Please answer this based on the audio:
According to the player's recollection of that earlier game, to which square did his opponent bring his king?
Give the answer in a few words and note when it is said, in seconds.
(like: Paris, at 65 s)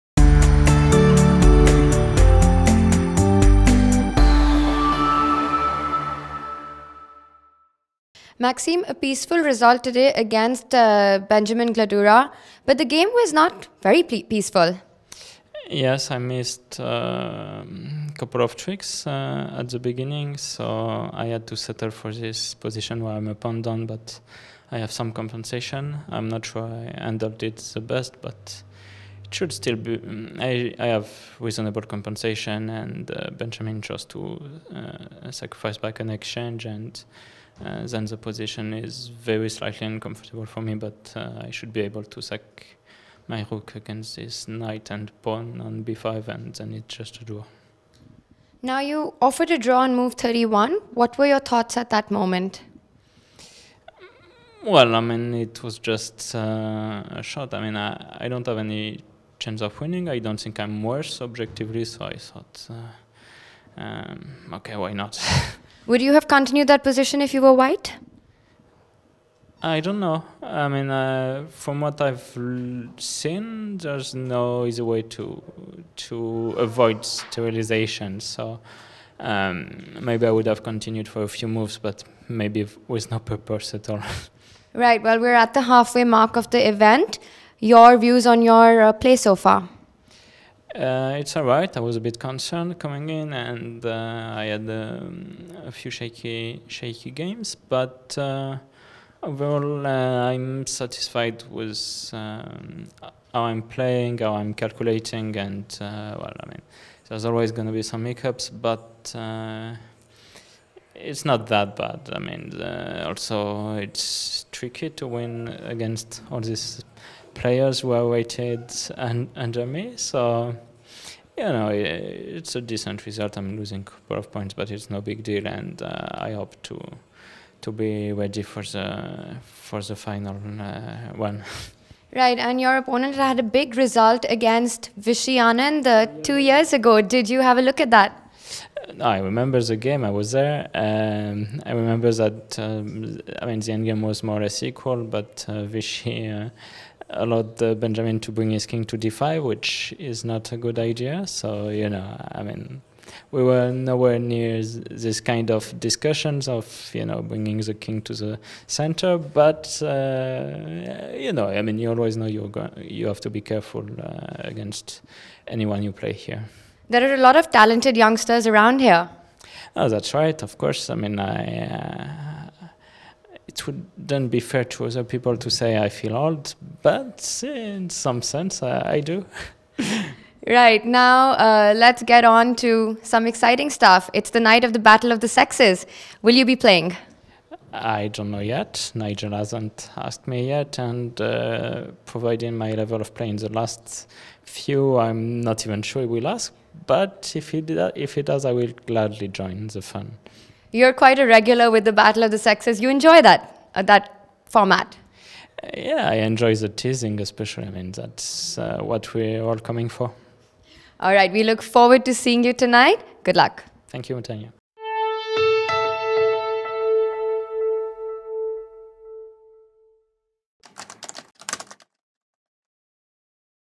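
d5, at 148 s.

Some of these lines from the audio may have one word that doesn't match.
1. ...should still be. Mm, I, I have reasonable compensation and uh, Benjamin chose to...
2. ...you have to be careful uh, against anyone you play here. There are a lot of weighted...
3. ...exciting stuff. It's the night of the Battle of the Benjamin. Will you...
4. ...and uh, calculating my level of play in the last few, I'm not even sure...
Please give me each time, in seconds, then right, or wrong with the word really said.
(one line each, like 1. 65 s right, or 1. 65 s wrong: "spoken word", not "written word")
1. 29 s right
2. 162 s wrong: "talented", not "weighted"
3. 183 s wrong: "Sexes", not "Benjamin"
4. 190 s wrong: "providing", not "calculating".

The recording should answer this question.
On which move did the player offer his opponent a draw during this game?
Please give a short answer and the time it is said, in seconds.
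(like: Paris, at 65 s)
31, at 49 s.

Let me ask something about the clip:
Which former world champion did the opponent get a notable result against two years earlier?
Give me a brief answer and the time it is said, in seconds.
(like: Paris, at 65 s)
Vishy Anand, at 134 s.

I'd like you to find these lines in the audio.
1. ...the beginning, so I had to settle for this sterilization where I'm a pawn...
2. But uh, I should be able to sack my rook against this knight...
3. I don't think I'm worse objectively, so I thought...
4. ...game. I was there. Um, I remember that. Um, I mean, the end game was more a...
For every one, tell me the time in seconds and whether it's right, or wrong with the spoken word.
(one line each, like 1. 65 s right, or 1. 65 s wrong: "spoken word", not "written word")
1. 19 s wrong: "position", not "sterilization"
2. 40 s right
3. 60 s right
4. 139 s right.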